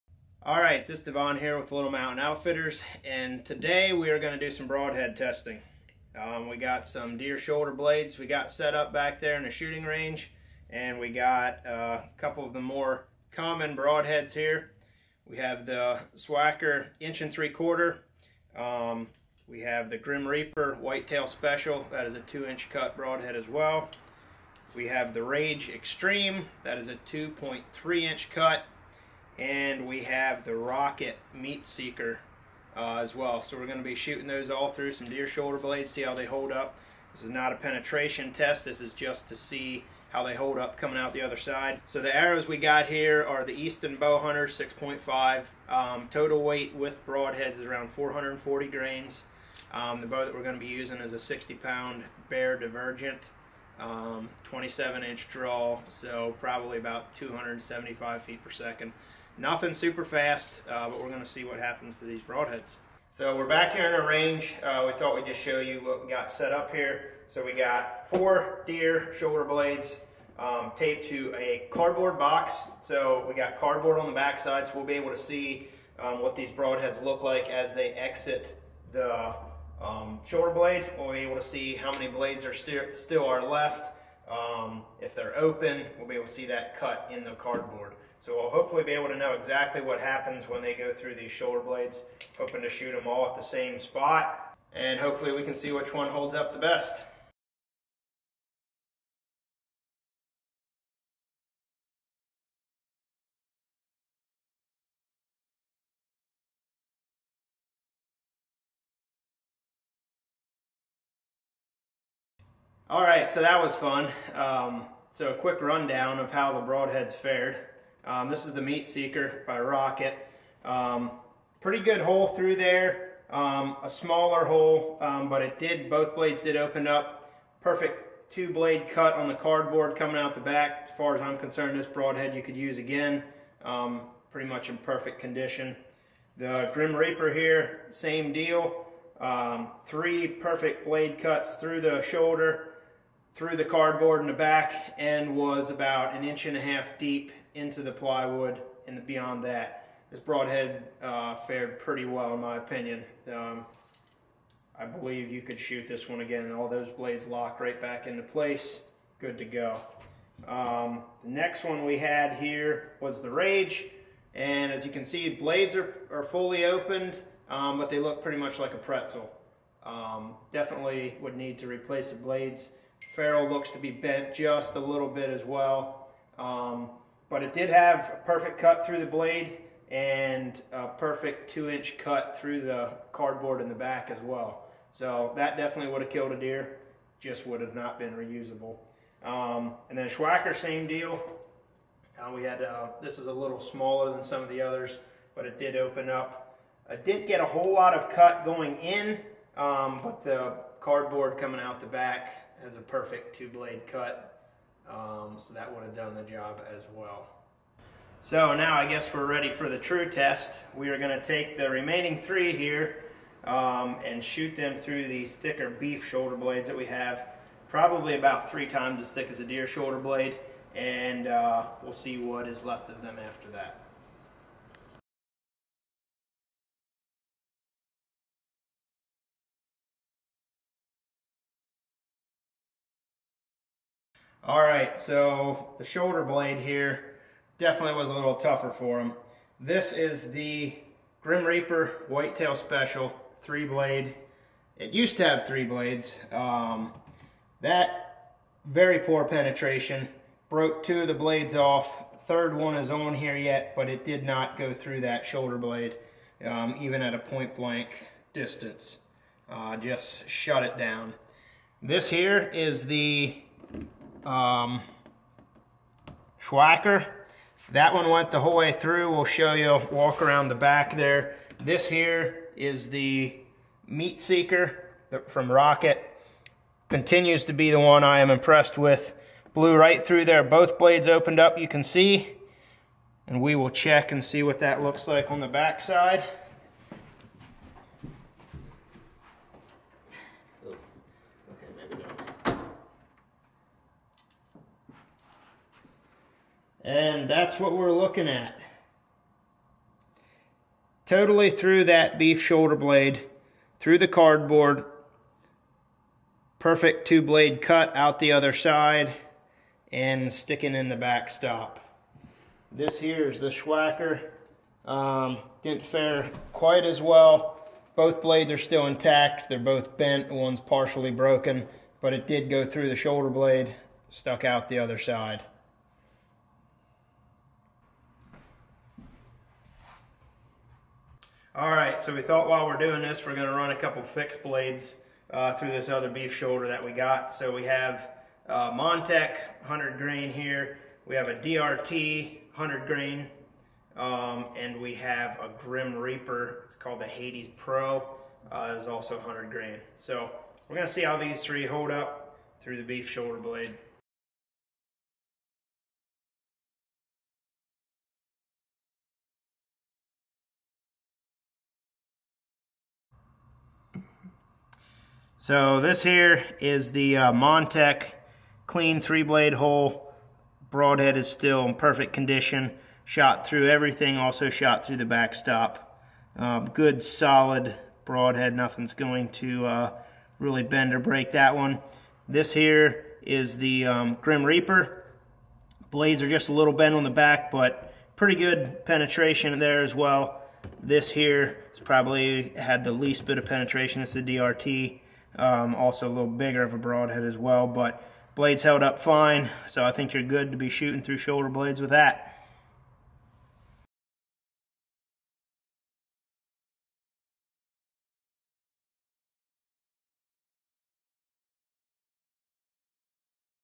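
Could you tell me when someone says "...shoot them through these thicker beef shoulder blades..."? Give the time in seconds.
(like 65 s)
214 s.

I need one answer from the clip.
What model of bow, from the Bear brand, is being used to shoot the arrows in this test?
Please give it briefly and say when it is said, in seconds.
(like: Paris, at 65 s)
Bear Divergent, at 52 s.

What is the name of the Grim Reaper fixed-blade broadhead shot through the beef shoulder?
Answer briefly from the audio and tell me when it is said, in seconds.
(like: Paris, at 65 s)
Hades Pro, at 347 s.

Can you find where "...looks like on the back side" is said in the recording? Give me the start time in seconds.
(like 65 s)
284 s.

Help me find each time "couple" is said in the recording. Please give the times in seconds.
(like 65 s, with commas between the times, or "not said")
12 s, 333 s.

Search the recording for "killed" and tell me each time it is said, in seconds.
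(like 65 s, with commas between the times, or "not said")
186 s.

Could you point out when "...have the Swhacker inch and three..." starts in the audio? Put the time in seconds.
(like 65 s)
15 s.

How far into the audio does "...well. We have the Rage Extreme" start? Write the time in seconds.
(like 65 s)
23 s.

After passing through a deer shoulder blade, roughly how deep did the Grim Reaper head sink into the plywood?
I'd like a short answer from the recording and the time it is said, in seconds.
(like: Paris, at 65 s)
an inch and a half, at 146 s.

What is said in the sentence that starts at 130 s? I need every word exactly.
As far as I'm concerned, this broadhead you could use again.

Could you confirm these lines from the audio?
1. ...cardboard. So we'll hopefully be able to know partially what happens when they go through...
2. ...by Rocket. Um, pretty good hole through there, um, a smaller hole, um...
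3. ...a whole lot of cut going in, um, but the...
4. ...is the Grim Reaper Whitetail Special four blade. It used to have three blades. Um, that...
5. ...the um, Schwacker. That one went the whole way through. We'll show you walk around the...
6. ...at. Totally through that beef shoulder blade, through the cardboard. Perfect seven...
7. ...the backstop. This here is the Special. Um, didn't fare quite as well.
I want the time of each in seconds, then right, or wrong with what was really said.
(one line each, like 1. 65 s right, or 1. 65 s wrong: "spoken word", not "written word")
1. 87 s wrong: "exactly", not "partially"
2. 119 s right
3. 197 s right
4. 239 s wrong: "three", not "four"
5. 262 s right
6. 298 s wrong: "two", not "seven"
7. 310 s wrong: "Schwacker", not "Special".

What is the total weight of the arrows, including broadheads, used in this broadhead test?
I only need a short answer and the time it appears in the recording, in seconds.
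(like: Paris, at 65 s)
440 grains, at 47 s.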